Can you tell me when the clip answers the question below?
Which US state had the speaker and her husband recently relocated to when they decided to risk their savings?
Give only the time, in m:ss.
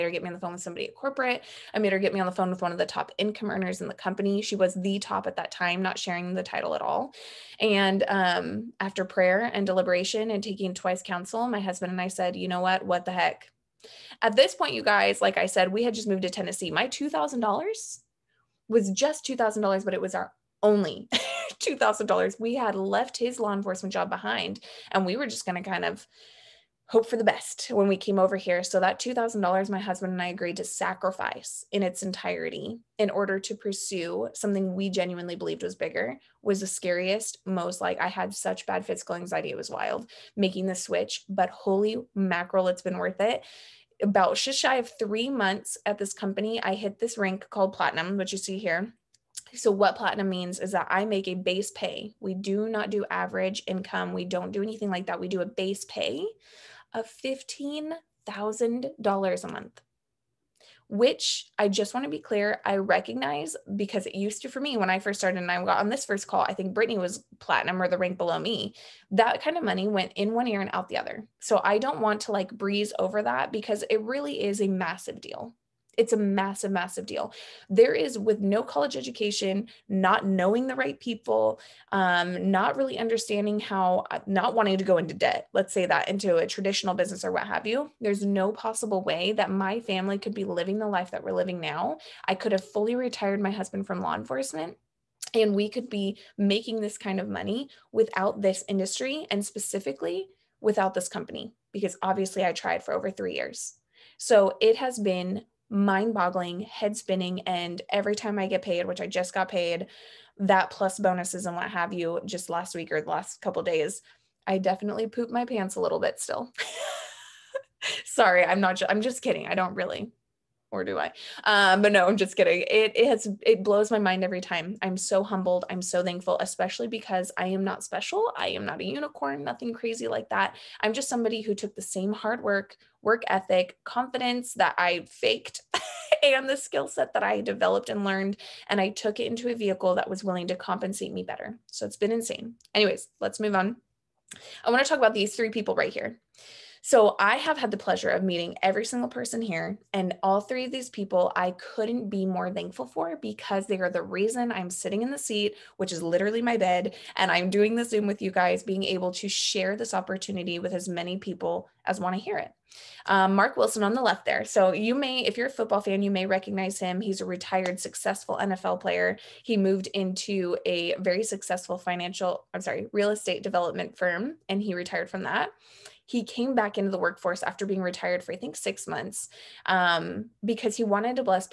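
0:16.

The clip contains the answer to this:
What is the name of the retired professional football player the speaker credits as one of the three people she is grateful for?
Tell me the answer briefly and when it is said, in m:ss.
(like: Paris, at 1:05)
Mark Wilson, at 2:43.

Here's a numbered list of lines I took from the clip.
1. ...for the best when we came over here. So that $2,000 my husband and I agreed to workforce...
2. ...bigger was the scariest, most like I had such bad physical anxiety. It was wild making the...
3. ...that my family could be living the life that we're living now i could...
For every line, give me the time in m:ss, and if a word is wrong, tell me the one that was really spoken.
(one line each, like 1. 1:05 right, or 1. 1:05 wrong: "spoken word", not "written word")
1. 0:27 wrong: "sacrifice", not "workforce"
2. 0:35 right
3. 1:29 right.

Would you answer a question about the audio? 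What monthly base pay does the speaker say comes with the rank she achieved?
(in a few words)
$15,000.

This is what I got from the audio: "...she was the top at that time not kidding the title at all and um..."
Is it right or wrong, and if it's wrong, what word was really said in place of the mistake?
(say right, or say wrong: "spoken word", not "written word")
wrong: "sharing", not "kidding".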